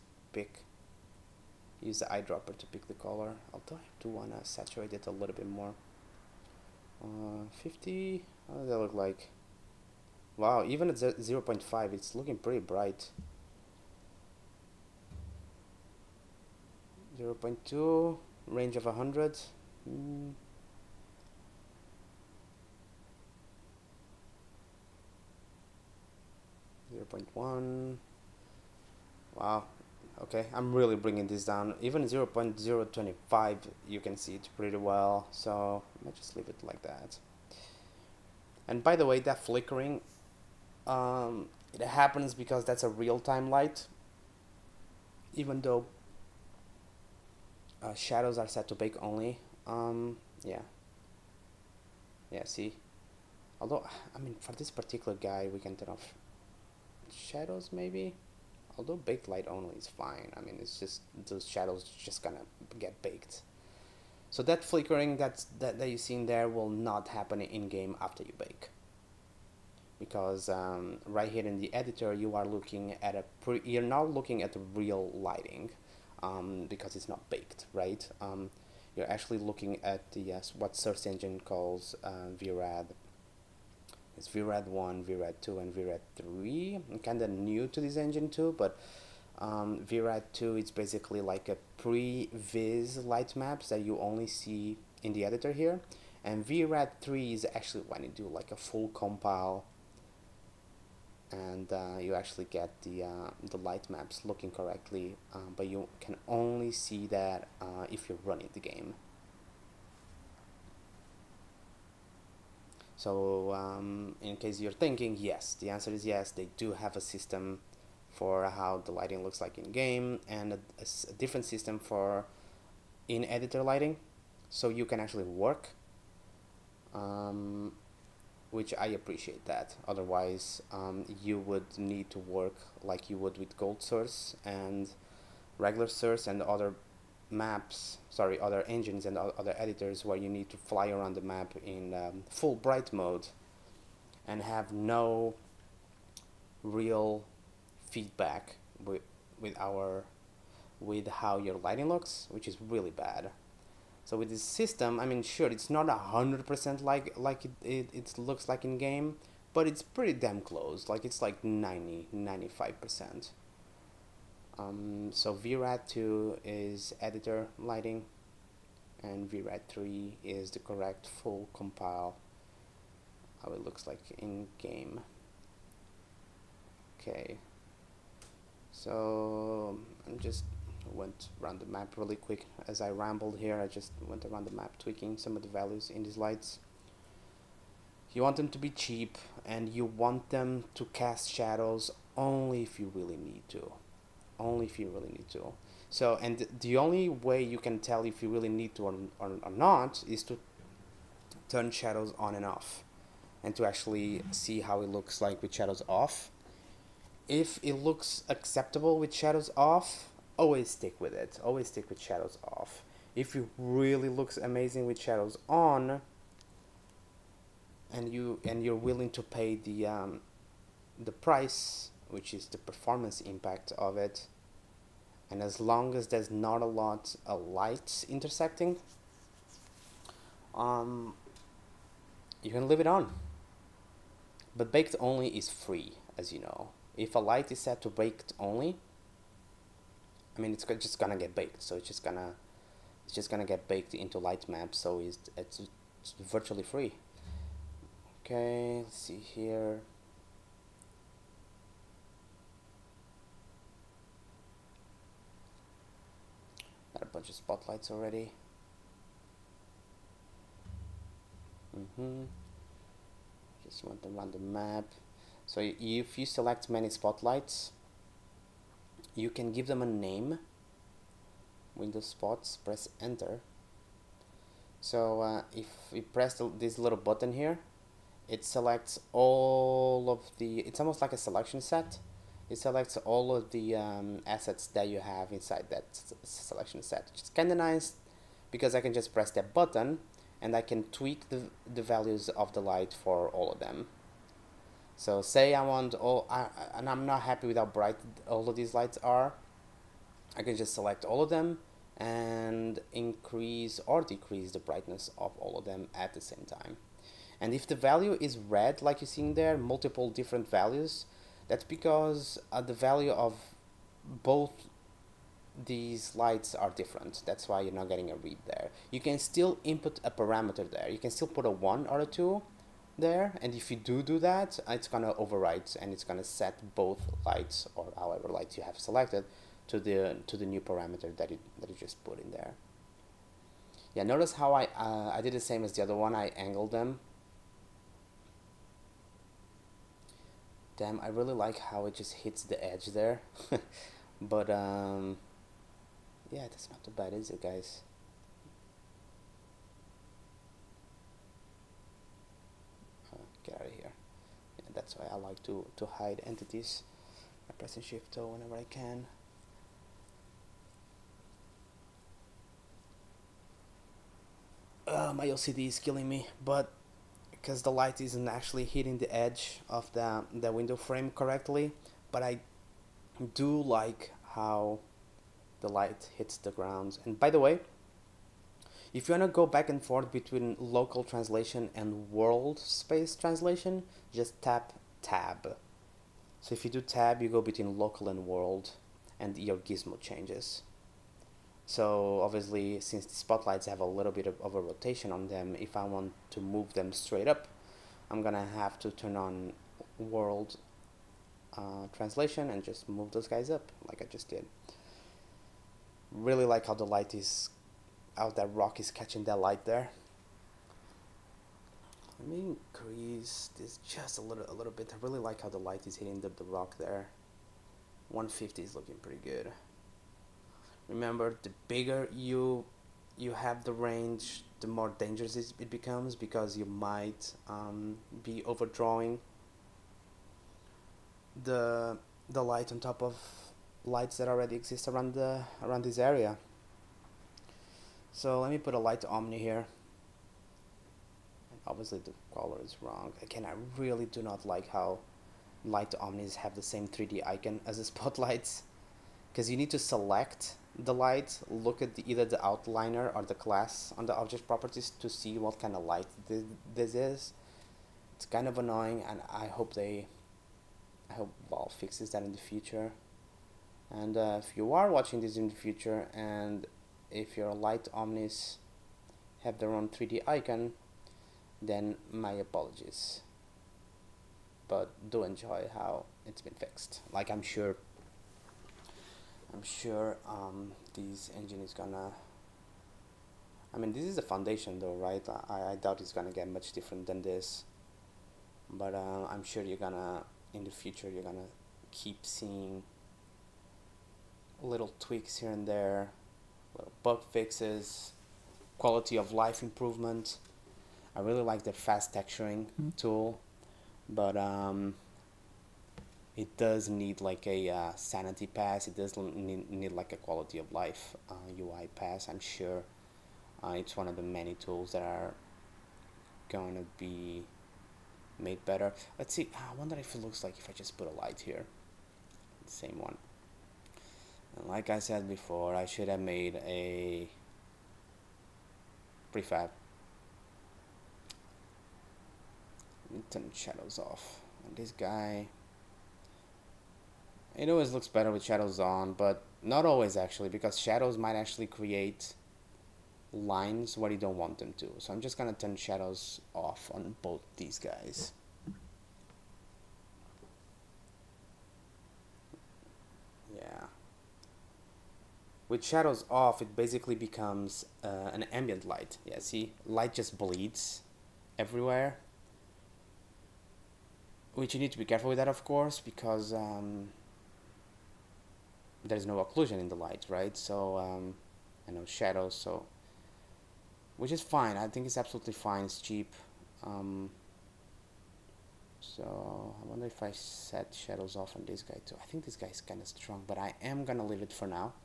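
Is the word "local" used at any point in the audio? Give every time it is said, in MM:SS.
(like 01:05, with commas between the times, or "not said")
06:20, 06:27.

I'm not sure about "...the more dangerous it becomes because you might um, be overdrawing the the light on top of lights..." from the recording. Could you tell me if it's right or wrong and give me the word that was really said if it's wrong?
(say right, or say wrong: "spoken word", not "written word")
right.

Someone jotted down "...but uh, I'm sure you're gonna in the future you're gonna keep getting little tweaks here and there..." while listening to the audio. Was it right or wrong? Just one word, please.
wrong.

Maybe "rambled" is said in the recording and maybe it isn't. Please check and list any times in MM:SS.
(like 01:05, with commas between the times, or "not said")
03:02.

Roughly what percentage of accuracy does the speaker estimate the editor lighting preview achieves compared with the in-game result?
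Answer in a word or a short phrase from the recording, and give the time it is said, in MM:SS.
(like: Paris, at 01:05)
90 to 95 percent, at 02:41.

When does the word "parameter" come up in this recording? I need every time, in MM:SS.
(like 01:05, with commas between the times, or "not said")
05:20, 05:30.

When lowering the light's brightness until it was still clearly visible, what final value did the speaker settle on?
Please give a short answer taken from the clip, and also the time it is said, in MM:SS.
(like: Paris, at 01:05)
0.025, at 00:32.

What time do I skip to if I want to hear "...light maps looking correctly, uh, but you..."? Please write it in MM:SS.
01:43.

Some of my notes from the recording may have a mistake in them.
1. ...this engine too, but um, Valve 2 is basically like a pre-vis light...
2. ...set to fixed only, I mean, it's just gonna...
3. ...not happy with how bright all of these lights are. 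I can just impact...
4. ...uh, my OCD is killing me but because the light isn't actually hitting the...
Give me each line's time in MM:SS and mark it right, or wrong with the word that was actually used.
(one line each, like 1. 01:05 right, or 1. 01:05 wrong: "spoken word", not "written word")
1. 01:27 wrong: "VRAD", not "Valve"
2. 03:57 wrong: "baked", not "fixed"
3. 04:57 wrong: "select", not "impact"
4. 06:04 right.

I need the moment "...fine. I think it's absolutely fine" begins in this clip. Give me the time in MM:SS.
09:34.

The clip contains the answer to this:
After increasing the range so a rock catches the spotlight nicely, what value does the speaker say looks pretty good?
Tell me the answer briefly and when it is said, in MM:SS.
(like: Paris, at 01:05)
150, at 06:58.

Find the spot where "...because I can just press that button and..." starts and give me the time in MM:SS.
04:48.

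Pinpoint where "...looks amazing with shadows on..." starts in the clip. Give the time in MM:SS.
03:34.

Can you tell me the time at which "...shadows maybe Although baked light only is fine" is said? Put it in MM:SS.
00:57.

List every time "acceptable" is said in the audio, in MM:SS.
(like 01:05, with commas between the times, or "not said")
03:28.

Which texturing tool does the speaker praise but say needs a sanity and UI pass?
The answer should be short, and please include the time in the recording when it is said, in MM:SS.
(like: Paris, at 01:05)
Fast texturing, at 08:21.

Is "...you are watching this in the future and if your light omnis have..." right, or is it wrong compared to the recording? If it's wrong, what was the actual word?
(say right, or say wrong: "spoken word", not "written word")
right.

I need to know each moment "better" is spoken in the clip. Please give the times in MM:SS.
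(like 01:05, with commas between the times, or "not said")
08:38, 08:58.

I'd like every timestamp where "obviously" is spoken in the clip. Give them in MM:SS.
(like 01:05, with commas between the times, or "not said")
06:32, 07:21.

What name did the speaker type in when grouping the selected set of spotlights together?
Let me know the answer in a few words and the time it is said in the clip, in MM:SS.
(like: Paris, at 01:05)
Window spots, at 04:31.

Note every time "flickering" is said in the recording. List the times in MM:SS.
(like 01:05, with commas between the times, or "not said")
00:39, 01:04.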